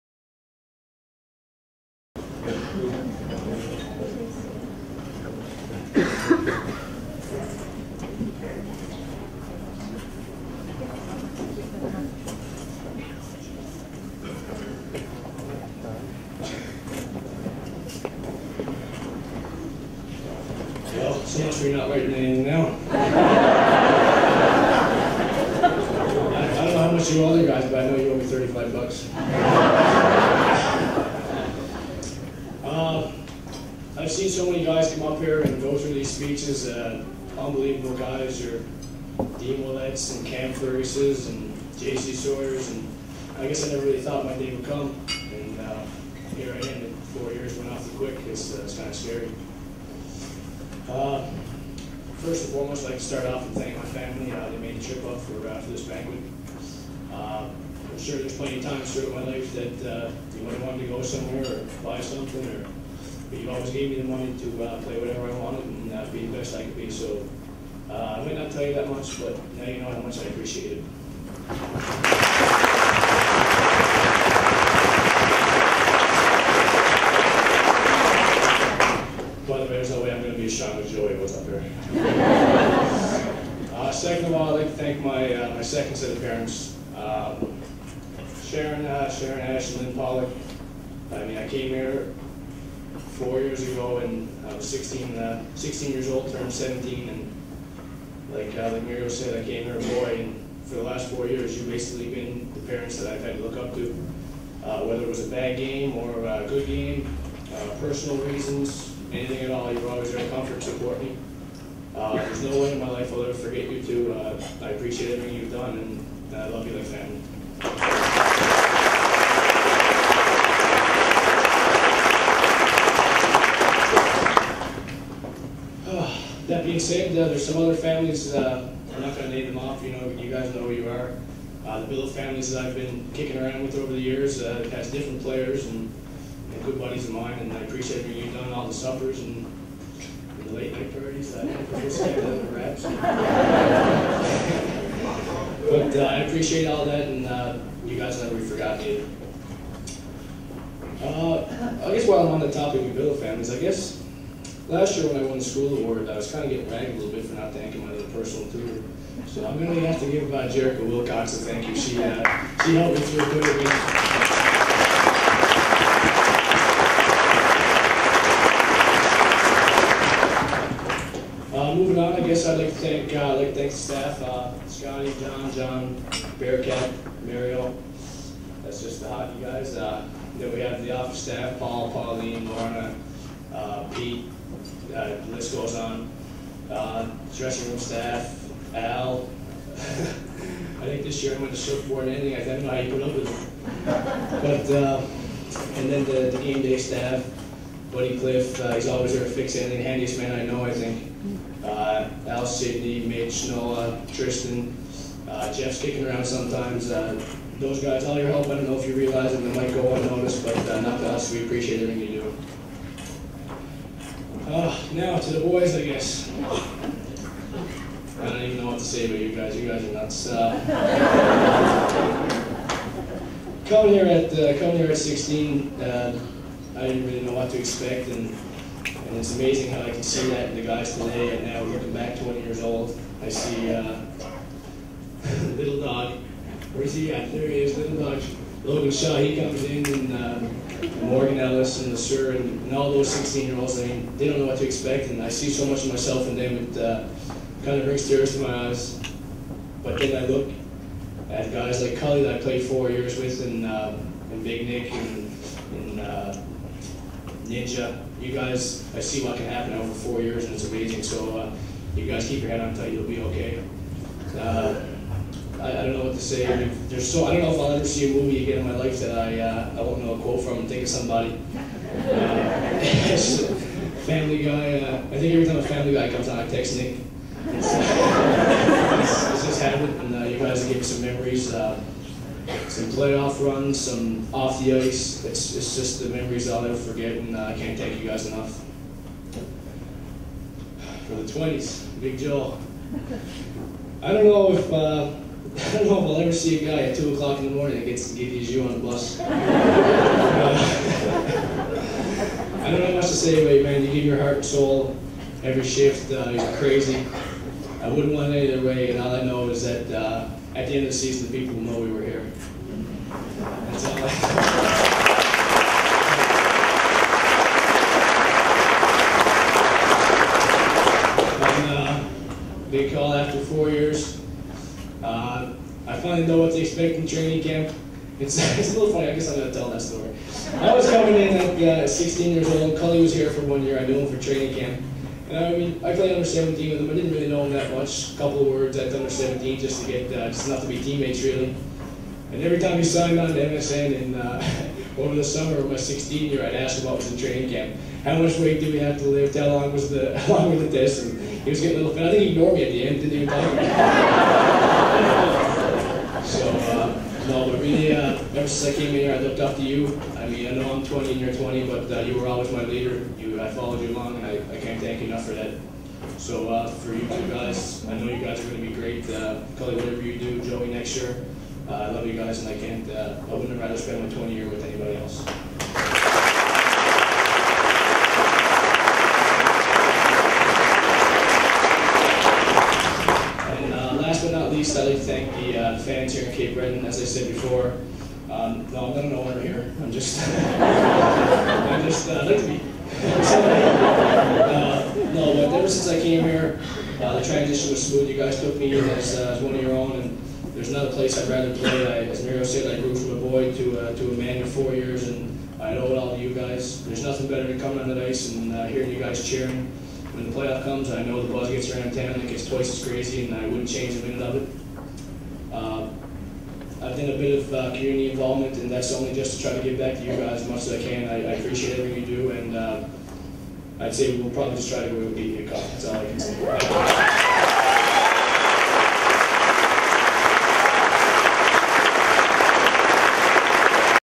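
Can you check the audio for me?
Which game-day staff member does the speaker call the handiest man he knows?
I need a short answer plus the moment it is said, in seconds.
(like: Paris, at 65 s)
Buddy Cliff, at 197 s.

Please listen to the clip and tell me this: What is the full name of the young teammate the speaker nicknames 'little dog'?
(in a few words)
Logan Shaw.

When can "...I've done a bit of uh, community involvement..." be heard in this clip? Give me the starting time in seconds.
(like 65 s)
416 s.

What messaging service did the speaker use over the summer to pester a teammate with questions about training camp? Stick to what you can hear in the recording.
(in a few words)
MSN.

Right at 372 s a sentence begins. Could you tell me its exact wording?
Uh, I wouldn't rather spend my 20 year with anybody else.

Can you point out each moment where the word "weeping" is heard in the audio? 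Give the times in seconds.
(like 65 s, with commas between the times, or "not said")
not said.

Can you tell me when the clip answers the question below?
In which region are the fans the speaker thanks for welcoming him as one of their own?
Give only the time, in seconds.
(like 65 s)
386 s.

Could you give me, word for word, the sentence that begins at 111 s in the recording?
Uh, there's no way in my life I'll ever forget you two.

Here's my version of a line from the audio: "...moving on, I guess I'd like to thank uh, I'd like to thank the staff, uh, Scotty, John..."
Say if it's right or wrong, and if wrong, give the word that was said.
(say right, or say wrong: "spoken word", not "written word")
right.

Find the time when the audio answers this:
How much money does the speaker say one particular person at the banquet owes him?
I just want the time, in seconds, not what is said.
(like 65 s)
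28 s.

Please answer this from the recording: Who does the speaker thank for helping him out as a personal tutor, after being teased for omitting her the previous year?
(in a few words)
Jerica Wilcox.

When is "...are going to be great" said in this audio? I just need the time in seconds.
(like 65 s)
368 s.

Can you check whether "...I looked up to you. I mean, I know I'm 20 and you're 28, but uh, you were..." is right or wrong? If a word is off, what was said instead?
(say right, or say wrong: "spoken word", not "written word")
wrong: "20", not "28".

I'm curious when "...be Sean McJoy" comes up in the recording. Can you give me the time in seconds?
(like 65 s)
80 s.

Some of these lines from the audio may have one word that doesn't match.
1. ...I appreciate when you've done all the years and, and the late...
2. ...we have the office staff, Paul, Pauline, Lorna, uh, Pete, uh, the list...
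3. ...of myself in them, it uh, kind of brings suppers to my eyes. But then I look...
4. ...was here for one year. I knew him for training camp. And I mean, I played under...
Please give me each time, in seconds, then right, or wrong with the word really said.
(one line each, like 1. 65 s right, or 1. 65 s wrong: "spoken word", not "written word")
1. 137 s wrong: "suppers", not "years"
2. 180 s right
3. 245 s wrong: "tears", not "suppers"
4. 333 s right.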